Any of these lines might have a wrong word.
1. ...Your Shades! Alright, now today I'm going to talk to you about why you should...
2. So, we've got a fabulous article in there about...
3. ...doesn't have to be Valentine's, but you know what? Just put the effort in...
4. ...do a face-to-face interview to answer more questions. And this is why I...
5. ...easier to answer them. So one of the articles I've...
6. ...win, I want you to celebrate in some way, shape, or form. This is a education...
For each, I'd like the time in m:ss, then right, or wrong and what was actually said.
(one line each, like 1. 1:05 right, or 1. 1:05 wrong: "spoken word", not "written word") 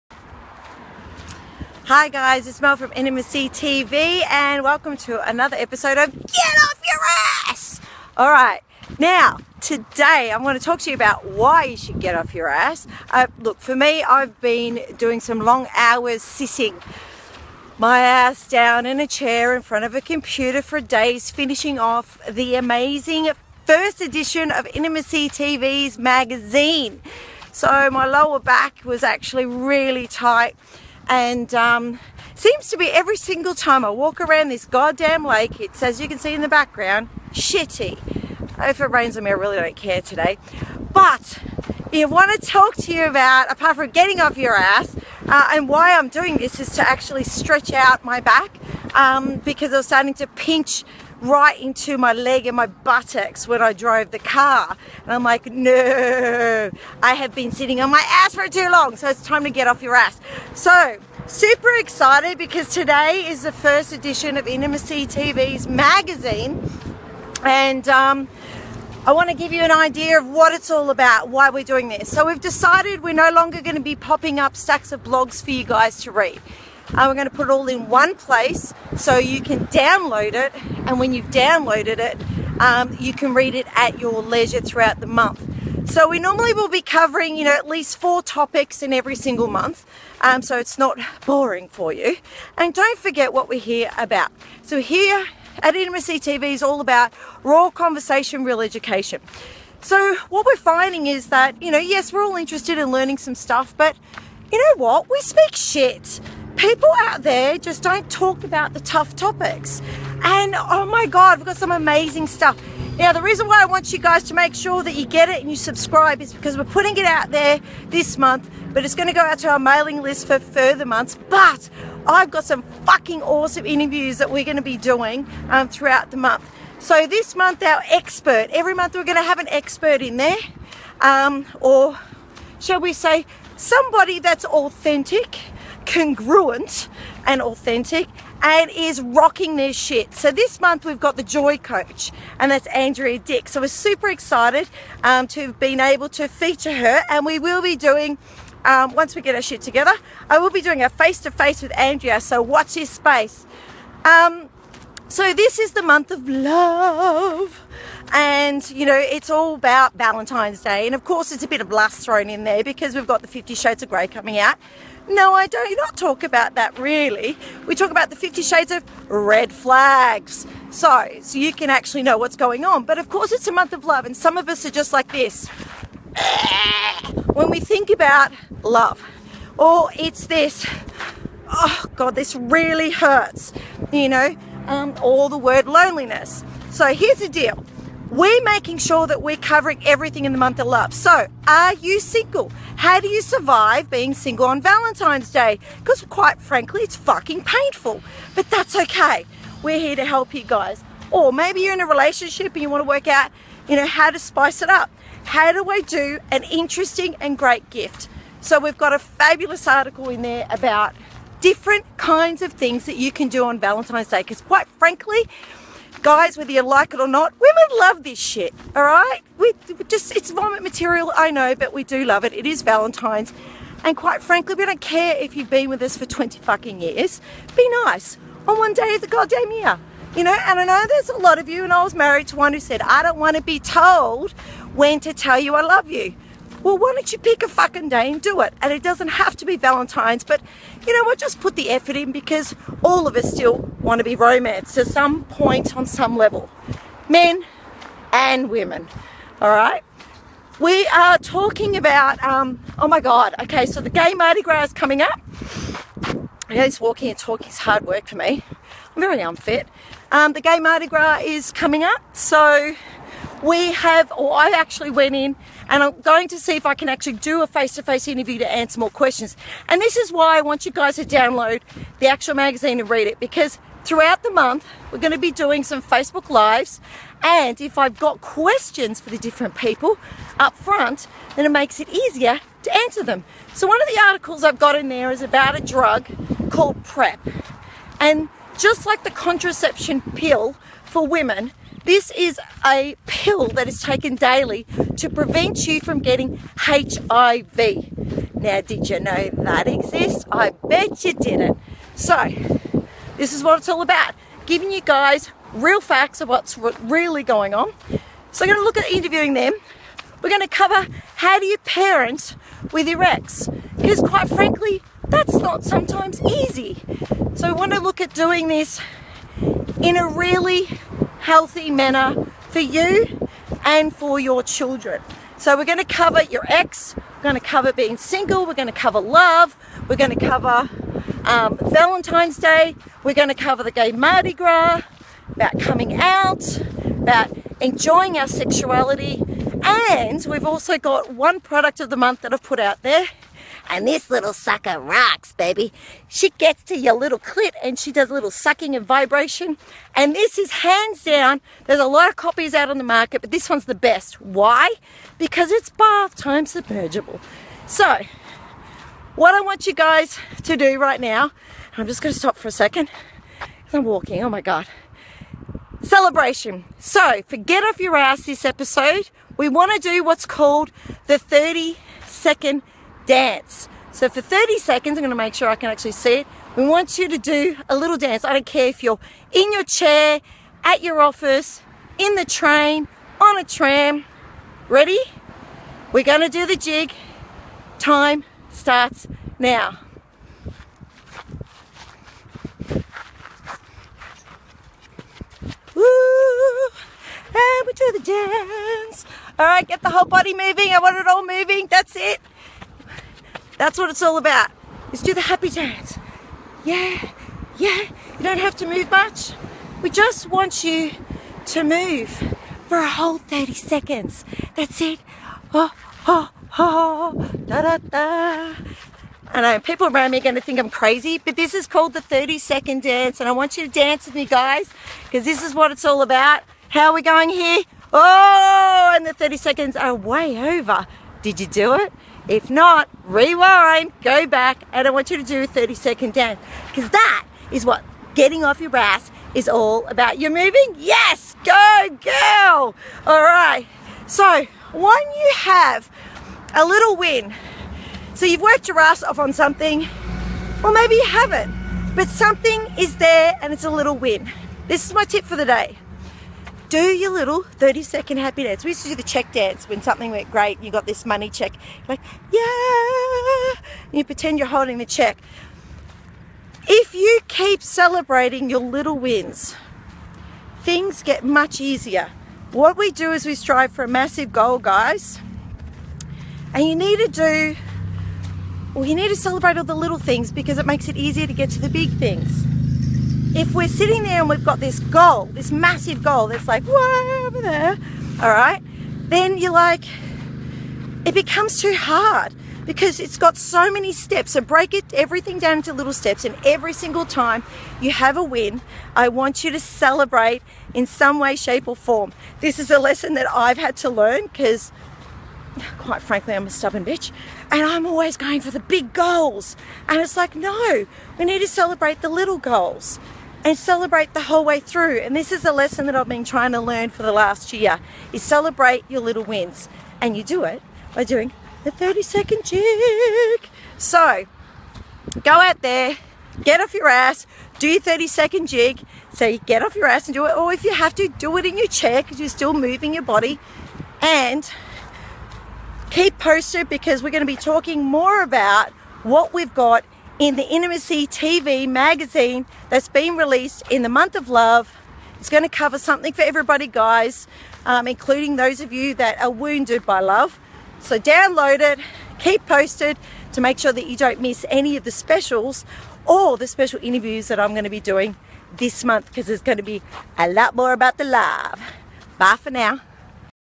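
1. 0:06 wrong: "Ass", not "Shades"
2. 3:28 right
3. 3:58 right
4. 4:27 right
5. 4:41 right
6. 8:18 wrong: "lesson", not "education".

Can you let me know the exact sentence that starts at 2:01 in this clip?
But I've got some fucking awesome interviews that we're going to be doing um, throughout the month.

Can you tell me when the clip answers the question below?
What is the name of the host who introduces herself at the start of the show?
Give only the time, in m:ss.
0:02.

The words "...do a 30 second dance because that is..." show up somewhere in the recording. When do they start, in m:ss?
7:15.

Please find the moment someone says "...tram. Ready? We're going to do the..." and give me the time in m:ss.
6:23.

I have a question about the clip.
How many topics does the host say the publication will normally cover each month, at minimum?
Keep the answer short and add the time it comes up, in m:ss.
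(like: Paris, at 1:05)
4, at 1:27.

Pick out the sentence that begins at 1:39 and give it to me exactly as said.
So what we're finding is that, you know, yes, we're all interested in learning some stuff, but you know what?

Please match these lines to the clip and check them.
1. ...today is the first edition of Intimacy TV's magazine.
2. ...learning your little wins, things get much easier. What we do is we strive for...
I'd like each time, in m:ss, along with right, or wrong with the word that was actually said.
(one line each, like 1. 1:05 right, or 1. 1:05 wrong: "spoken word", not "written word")
1. 1:02 right
2. 7:47 wrong: "celebrating", not "learning".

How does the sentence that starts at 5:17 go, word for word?
So, we want to look at doing this in a really healthy manner for you and for your children.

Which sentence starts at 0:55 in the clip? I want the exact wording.
And I'm like, no, I have been sitting on my ass for too long.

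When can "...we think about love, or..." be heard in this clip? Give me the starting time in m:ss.
2:57.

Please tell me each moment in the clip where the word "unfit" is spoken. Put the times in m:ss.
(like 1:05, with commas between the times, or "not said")
4:19.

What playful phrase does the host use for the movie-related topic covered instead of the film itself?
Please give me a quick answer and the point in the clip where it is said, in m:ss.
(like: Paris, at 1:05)
50 shades of red flags, at 2:48.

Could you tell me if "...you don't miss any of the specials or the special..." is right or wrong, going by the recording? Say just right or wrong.
right.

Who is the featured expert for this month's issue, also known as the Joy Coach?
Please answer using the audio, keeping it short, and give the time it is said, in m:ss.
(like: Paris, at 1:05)
Andrea Dick, at 2:22.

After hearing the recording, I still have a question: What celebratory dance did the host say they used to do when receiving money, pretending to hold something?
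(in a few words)
check dance.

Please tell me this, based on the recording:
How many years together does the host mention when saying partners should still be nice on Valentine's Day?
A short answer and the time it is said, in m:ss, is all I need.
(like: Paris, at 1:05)
20, at 3:46.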